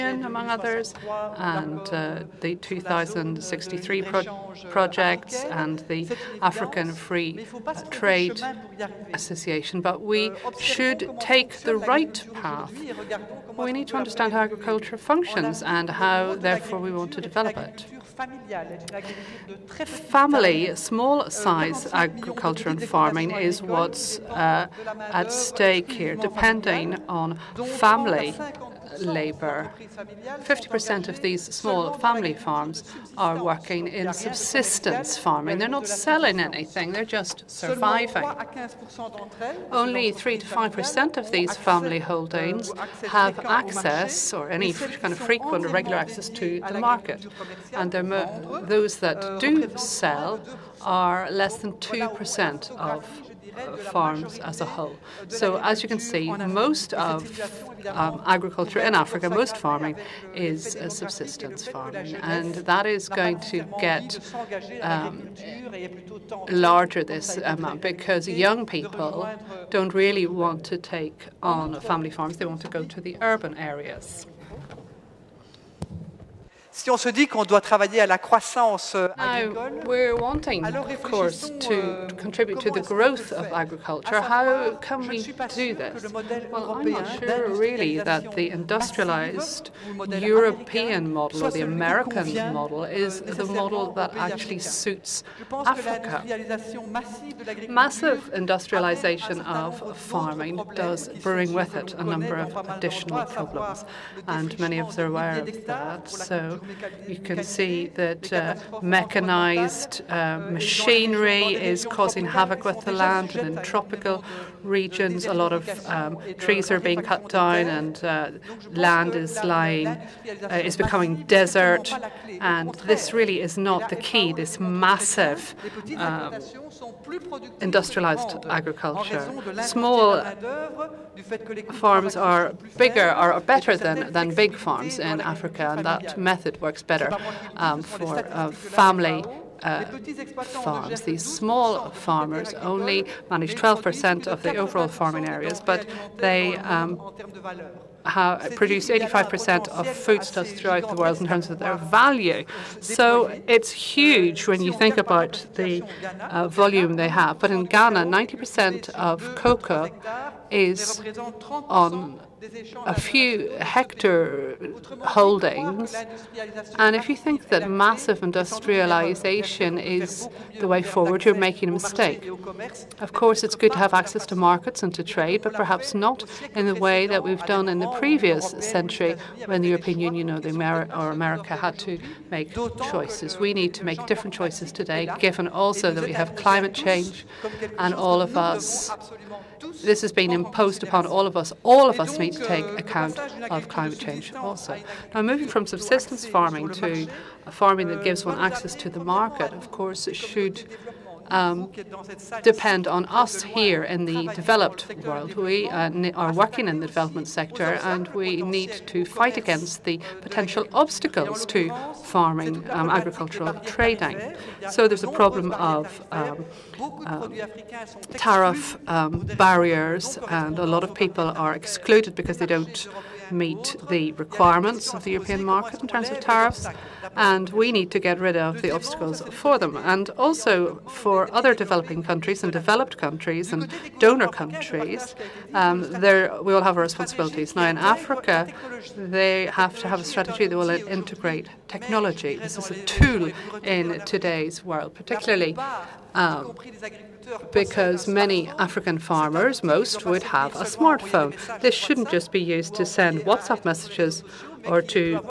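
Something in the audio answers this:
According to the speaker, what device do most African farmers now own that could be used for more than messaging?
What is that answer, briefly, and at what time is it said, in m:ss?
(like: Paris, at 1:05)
smartphone, at 4:10.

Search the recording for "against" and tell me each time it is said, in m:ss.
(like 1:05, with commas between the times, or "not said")
3:29.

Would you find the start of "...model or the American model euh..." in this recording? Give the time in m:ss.
1:31.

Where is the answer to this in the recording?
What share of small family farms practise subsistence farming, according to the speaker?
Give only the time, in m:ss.
0:30.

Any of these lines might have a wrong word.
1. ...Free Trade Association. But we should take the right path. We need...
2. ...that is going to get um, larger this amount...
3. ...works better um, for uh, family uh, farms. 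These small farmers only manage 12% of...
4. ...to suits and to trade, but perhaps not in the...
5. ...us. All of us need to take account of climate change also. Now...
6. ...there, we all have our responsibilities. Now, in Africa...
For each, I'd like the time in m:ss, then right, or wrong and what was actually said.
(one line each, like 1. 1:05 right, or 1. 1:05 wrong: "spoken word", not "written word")
1. 0:06 right
2. 1:02 right
3. 2:16 right
4. 2:54 wrong: "markets", not "suits"
5. 3:11 right
6. 3:56 right.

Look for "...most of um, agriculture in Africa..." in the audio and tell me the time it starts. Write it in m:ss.
0:56.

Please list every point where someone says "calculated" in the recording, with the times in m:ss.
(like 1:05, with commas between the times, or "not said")
not said.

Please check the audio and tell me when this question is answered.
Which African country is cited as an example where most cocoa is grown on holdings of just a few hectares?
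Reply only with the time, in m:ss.
2:37.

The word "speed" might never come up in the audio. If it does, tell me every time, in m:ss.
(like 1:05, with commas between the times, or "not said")
not said.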